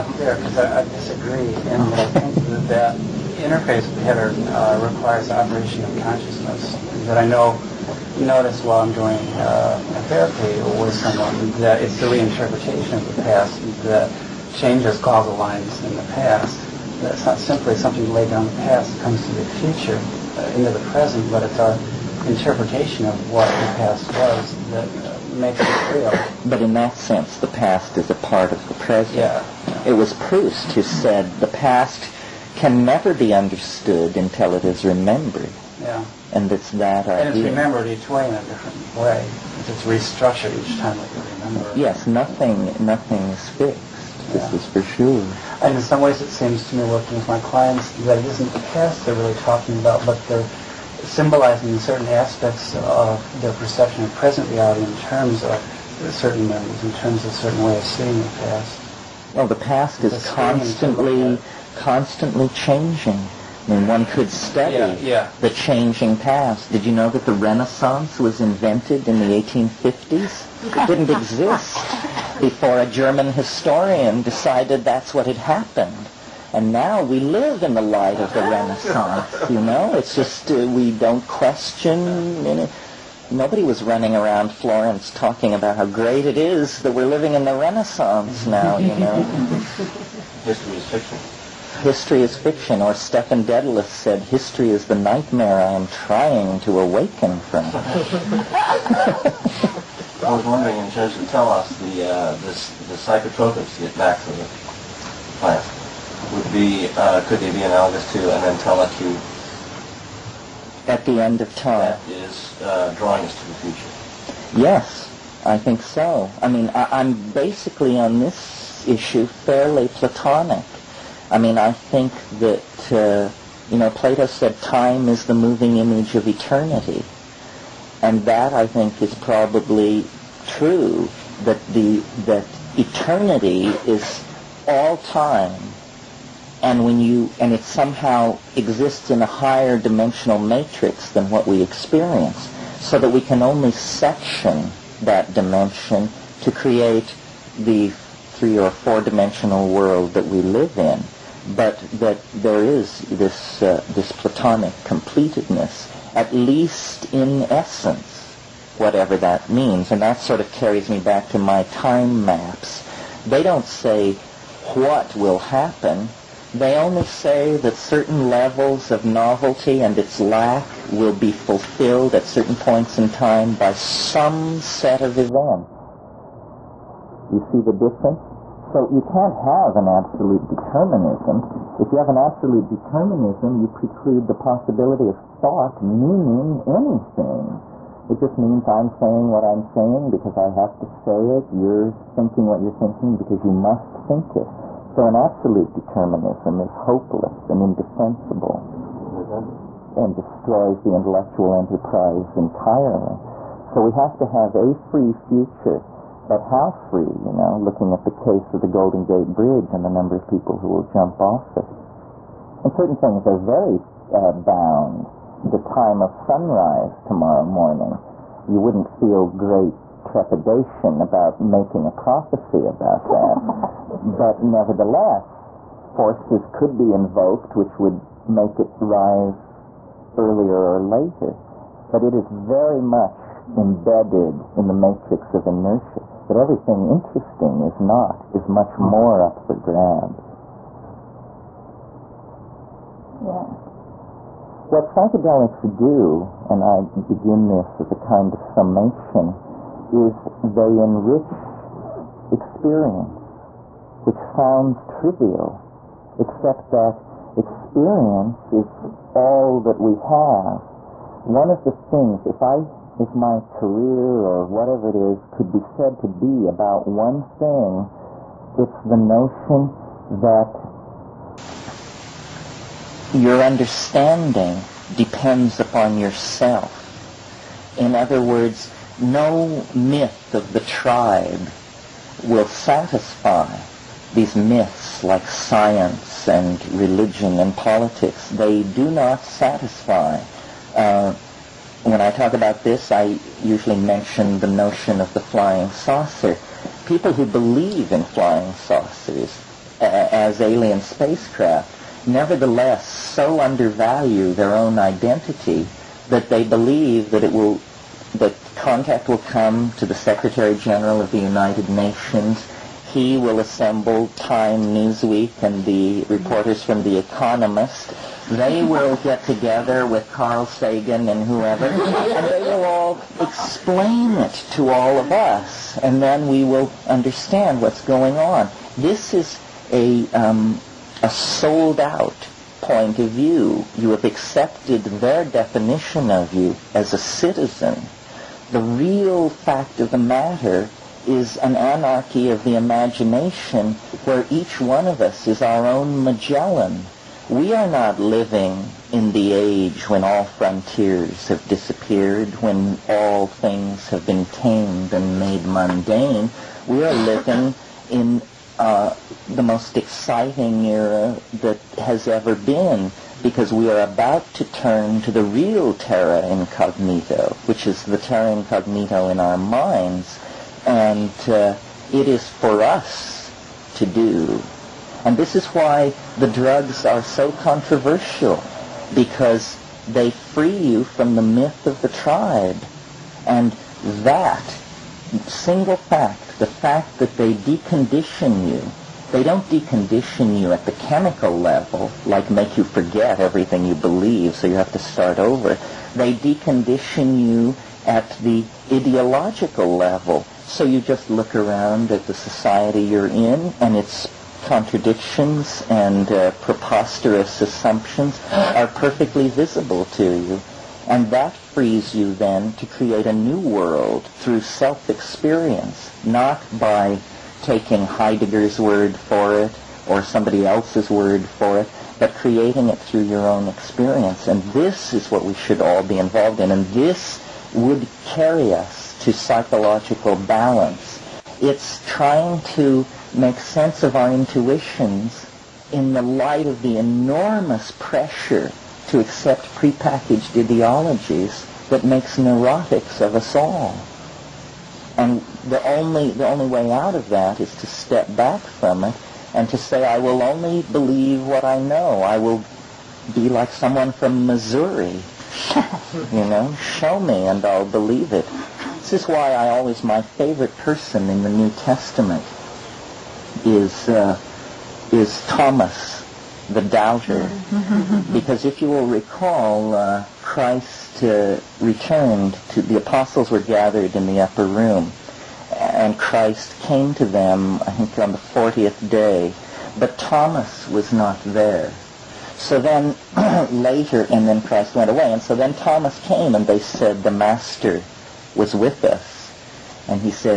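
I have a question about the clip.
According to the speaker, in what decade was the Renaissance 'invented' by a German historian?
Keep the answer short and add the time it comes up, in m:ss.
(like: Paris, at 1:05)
1850s, at 1:09.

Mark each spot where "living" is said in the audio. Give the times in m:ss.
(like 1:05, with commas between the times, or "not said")
1:27, 5:47, 5:56.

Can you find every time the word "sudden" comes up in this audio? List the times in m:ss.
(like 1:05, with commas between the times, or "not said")
not said.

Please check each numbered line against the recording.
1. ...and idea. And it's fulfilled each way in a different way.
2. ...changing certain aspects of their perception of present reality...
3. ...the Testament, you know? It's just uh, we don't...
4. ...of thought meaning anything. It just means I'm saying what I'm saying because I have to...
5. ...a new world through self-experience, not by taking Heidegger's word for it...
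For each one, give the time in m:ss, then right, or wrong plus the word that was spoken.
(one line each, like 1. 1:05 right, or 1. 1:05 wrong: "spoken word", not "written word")
1. 0:37 wrong: "remembered", not "fulfilled"
2. 0:51 wrong: "symbolizing", not "changing"
3. 1:18 wrong: "Renaissance", not "Testament"
4. 3:05 right
5. 6:53 right.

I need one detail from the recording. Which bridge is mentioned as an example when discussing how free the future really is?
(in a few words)
Golden Gate Bridge.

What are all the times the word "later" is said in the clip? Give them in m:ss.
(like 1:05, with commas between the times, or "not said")
3:50, 8:03.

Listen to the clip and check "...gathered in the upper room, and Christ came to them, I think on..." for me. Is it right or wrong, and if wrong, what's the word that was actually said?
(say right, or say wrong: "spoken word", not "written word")
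right.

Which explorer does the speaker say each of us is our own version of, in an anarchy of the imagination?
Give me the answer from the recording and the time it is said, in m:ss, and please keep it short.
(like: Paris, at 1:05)
Magellan, at 5:46.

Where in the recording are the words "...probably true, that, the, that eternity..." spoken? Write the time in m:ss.
2:09.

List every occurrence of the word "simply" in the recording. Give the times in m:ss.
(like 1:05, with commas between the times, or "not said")
0:17.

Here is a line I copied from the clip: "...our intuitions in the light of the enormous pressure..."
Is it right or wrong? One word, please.
right.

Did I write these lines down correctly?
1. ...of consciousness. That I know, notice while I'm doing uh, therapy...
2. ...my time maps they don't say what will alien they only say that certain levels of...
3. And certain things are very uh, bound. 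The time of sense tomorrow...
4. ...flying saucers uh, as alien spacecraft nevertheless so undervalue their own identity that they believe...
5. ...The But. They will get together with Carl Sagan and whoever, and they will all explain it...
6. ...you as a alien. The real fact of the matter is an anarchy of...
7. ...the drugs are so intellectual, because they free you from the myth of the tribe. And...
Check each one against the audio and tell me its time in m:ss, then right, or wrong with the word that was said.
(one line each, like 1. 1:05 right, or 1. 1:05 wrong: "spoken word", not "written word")
1. 0:05 right
2. 2:41 wrong: "happen", not "alien"
3. 3:32 wrong: "sunrise", not "sense"
4. 4:58 right
5. 5:16 wrong: "Economist", not "But"
6. 5:36 wrong: "citizen", not "alien"
7. 6:16 wrong: "controversial", not "intellectual".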